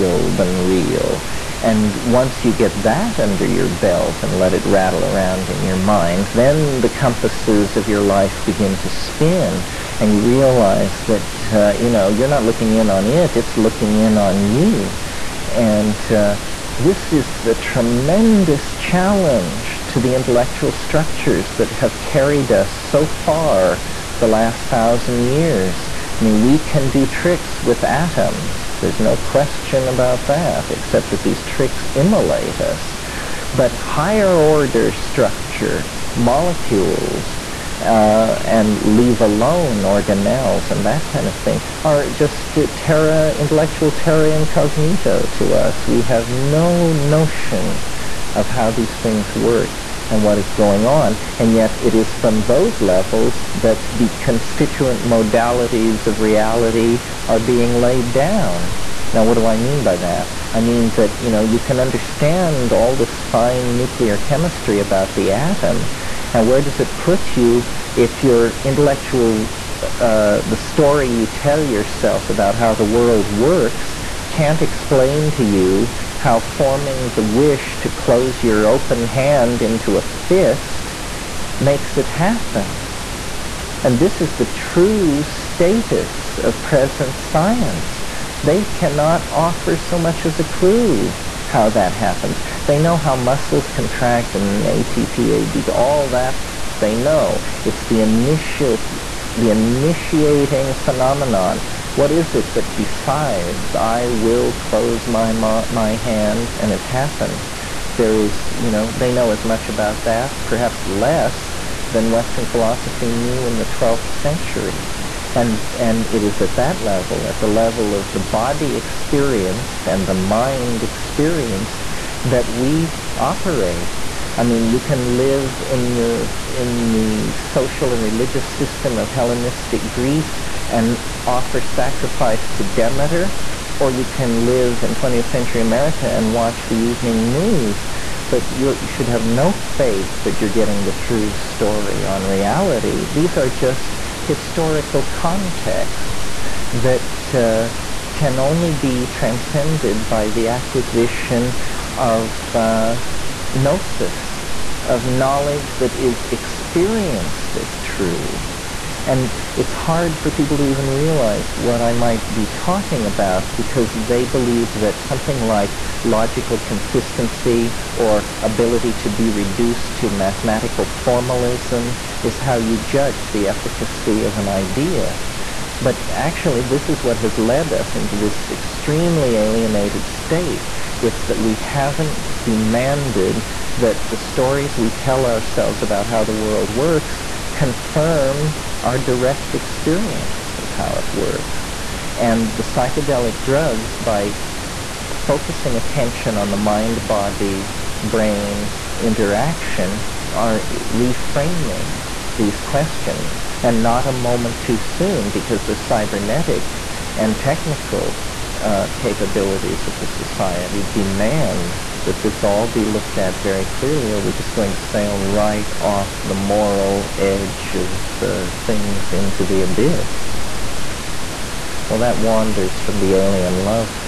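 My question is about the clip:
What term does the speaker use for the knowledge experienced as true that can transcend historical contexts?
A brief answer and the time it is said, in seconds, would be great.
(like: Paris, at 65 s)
gnosis, at 153 s.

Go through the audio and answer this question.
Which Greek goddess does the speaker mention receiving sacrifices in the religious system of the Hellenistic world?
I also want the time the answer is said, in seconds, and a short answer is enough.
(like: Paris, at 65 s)
Demeter, at 132 s.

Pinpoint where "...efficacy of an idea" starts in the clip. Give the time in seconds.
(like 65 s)
173 s.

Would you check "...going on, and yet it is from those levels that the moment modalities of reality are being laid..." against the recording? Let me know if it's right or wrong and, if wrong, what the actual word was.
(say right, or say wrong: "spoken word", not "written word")
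wrong: "constituent", not "moment".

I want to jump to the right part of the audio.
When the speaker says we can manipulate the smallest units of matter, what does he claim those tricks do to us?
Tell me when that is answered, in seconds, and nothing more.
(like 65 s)
31 s.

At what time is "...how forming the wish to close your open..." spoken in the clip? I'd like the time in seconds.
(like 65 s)
76 s.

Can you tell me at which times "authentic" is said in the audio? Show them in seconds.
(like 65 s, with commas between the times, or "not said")
not said.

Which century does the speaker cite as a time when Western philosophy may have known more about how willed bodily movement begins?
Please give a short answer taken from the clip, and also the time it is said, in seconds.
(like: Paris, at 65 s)
12th century, at 113 s.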